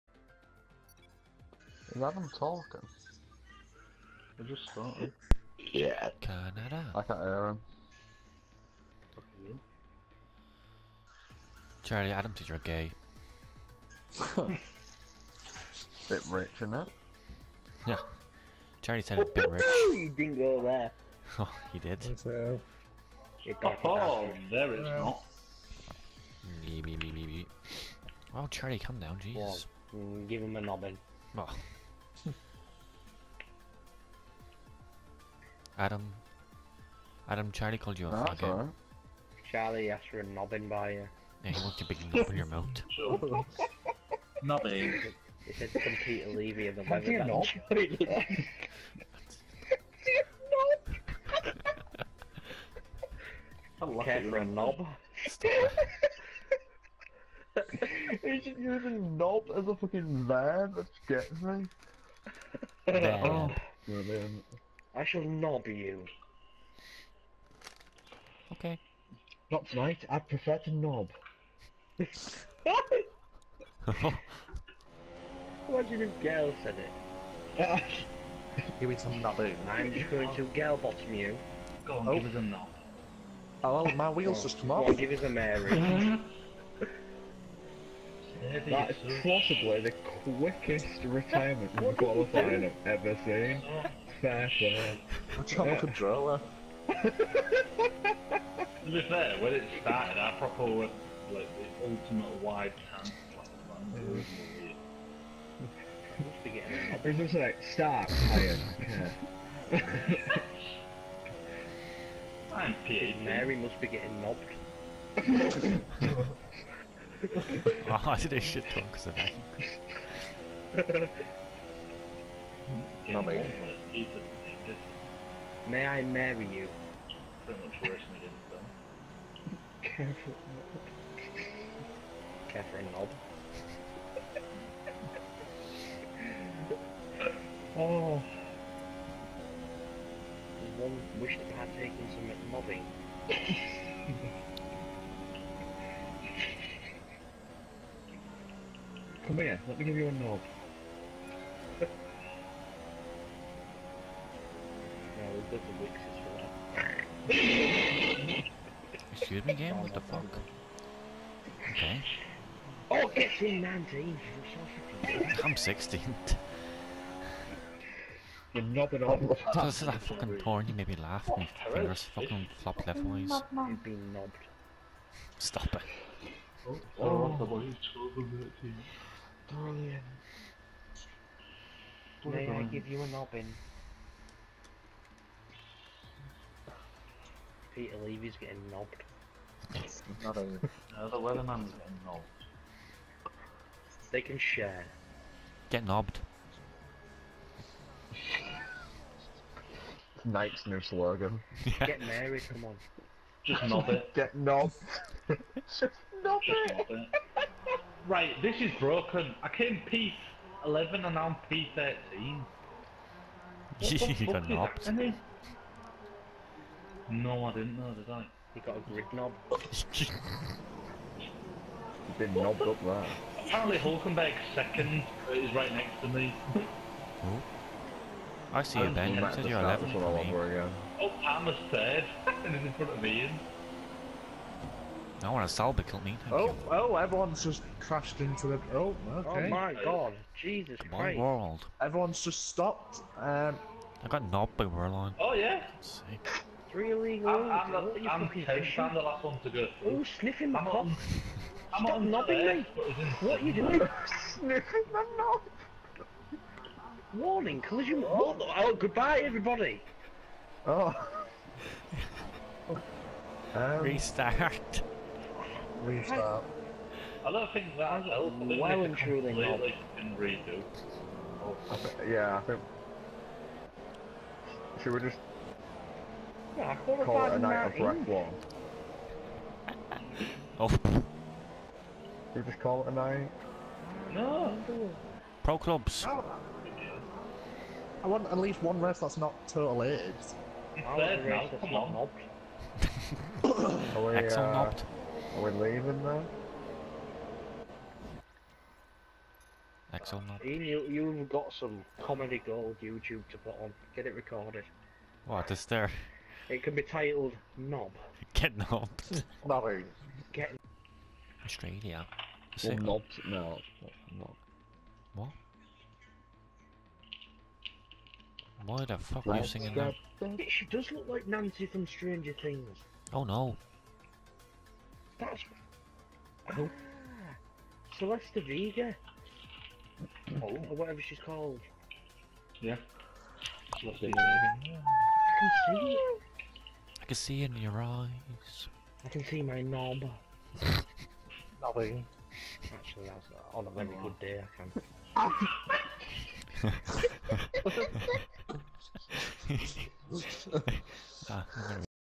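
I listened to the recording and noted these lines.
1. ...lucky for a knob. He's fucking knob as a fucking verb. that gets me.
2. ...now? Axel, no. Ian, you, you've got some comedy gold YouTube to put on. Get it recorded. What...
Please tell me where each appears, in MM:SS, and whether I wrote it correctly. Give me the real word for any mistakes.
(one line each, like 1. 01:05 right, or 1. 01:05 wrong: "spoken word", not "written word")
1. 00:53 wrong: "using", not "fucking"
2. 04:56 right.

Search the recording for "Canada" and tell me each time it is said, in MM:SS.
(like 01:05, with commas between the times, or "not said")
00:06.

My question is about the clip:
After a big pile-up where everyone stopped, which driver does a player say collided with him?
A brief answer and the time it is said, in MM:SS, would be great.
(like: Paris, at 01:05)
Wehrlein, at 04:04.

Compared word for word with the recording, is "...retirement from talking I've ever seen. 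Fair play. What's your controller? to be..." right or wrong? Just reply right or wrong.
wrong.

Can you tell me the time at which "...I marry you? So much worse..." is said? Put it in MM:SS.
02:05.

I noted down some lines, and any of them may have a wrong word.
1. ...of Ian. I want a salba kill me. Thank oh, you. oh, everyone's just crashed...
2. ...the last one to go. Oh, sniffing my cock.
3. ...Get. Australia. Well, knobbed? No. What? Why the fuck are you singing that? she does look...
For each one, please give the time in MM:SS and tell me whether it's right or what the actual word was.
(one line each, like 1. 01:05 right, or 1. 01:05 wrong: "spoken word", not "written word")
1. 03:52 right
2. 04:08 right
3. 05:10 right.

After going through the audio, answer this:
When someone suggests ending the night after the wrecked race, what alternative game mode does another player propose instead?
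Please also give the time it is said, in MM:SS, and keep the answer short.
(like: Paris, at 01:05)
Pro Clubs, at 04:45.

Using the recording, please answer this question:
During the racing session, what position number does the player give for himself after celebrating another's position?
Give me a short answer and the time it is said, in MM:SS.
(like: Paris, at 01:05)
16, at 02:45.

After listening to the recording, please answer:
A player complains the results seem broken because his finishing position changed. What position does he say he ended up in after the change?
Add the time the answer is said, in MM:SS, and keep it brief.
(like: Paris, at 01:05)
P13, at 03:31.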